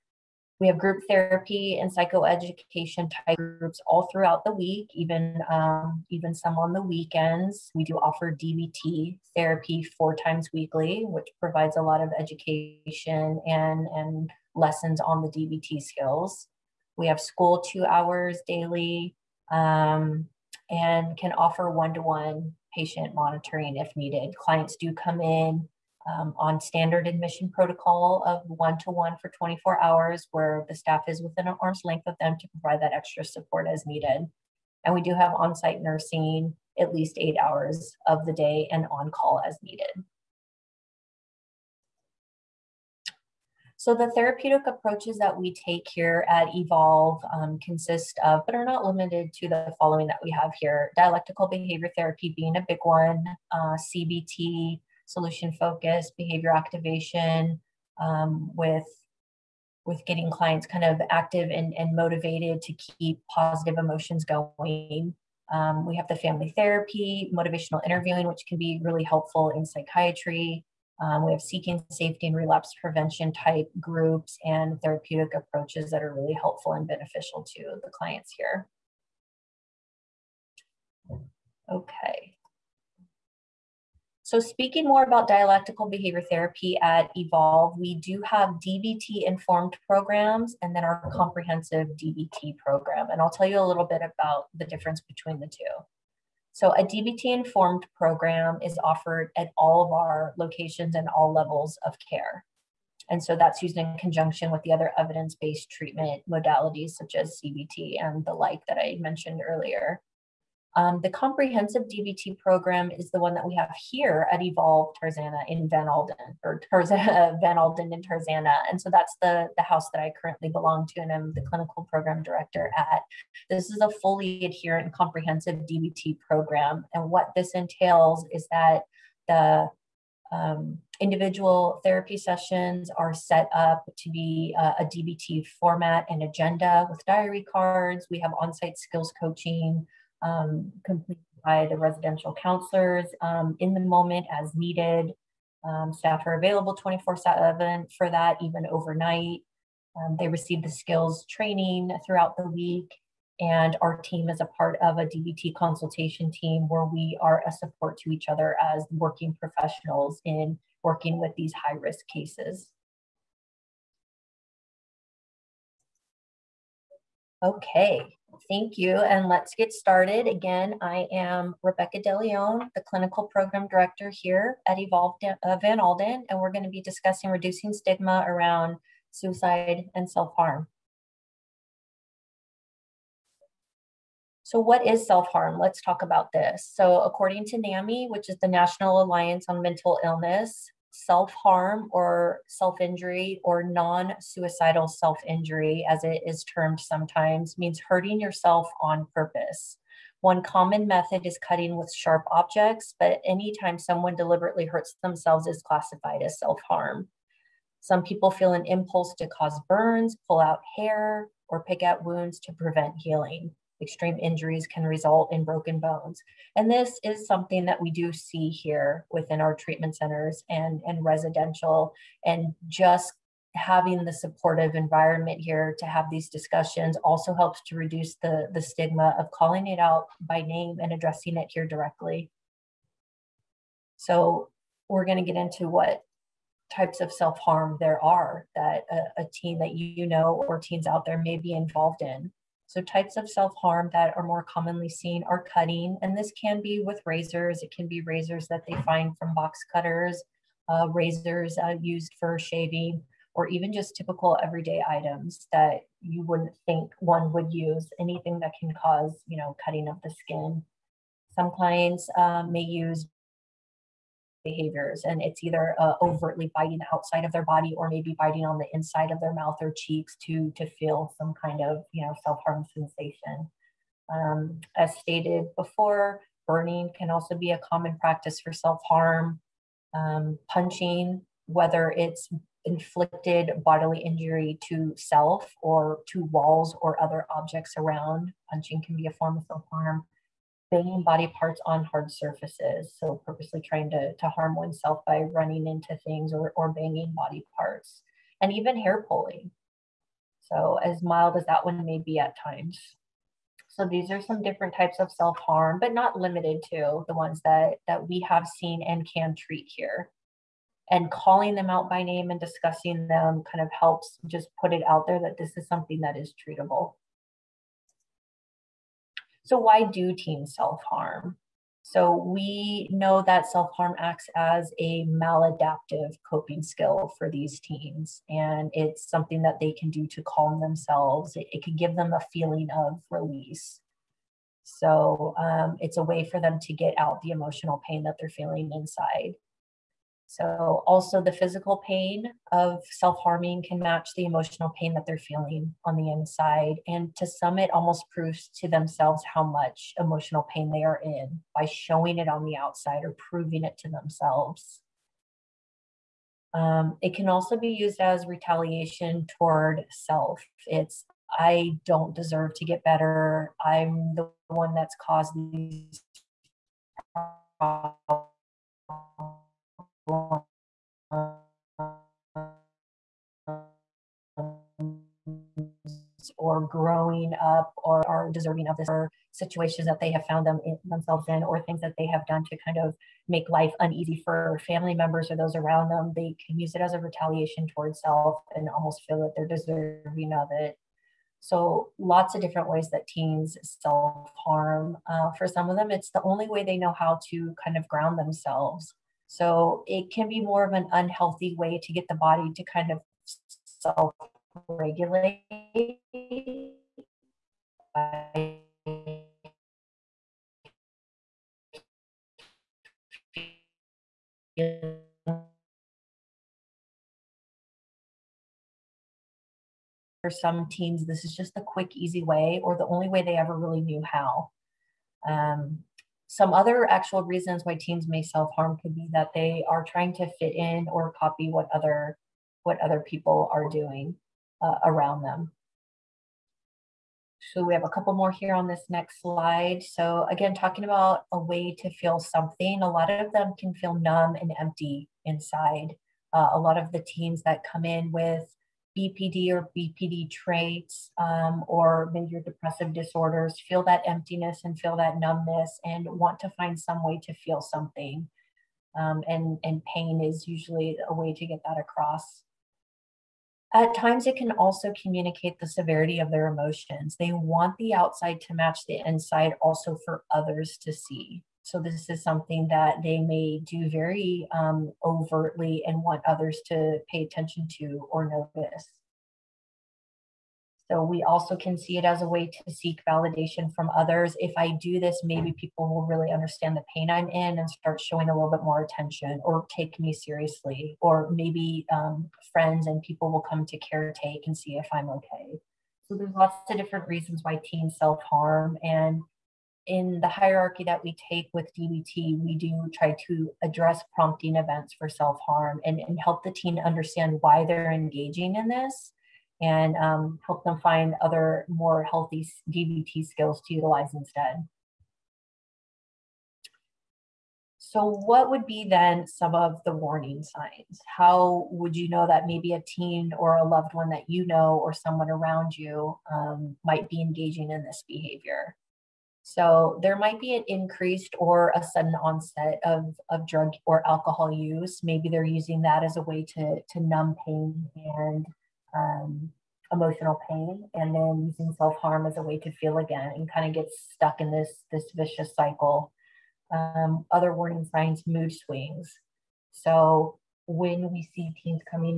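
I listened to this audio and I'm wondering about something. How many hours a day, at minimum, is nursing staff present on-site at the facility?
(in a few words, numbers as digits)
8.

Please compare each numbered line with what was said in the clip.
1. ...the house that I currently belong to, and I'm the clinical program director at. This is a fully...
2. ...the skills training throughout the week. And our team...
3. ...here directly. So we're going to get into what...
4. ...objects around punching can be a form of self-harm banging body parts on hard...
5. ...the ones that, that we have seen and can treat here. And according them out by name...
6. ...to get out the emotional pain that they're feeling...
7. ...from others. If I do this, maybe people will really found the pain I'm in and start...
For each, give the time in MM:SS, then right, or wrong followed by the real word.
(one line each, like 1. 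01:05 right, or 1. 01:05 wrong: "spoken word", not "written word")
1. 01:59 right
2. 02:30 right
3. 03:51 right
4. 04:47 right
5. 05:07 wrong: "calling", not "according"
6. 05:36 right
7. 08:03 wrong: "understand", not "found".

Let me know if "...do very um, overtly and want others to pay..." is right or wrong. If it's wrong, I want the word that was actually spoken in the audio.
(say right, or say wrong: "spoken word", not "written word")
right.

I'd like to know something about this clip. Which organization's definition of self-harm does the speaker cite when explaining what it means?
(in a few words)
NAMI.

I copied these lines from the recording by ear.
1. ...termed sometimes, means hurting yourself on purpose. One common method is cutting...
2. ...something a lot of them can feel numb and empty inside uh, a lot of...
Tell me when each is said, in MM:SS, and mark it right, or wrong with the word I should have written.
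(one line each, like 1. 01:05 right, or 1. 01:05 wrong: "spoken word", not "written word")
1. 03:16 right
2. 07:22 right.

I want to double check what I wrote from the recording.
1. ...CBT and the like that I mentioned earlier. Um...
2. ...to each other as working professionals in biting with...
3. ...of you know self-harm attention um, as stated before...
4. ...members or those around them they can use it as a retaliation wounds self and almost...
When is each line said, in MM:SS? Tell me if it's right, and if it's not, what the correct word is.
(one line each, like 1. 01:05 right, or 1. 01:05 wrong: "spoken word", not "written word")
1. 01:47 right
2. 02:37 wrong: "working", not "biting"
3. 04:31 wrong: "sensation", not "attention"
4. 06:24 wrong: "towards", not "wounds".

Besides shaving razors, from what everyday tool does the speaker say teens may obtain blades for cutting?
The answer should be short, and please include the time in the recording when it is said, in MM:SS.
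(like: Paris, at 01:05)
box cutters, at 04:09.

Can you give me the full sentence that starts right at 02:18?
We have on site skills coaching um, completed by the residential counselors um, in the moment as needed.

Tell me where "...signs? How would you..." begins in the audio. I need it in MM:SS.
08:40.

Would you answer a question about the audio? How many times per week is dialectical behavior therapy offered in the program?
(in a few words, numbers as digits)
4.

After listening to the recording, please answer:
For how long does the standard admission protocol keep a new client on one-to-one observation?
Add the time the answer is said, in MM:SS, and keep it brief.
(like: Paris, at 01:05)
24 hours, at 00:29.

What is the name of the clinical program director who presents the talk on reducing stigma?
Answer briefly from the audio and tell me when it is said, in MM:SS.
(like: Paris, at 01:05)
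Rebecca DeLeon, at 02:51.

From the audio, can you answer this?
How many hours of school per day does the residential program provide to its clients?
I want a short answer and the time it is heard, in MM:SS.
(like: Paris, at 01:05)
2, at 00:17.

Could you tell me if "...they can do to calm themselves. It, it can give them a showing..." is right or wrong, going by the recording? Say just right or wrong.
wrong.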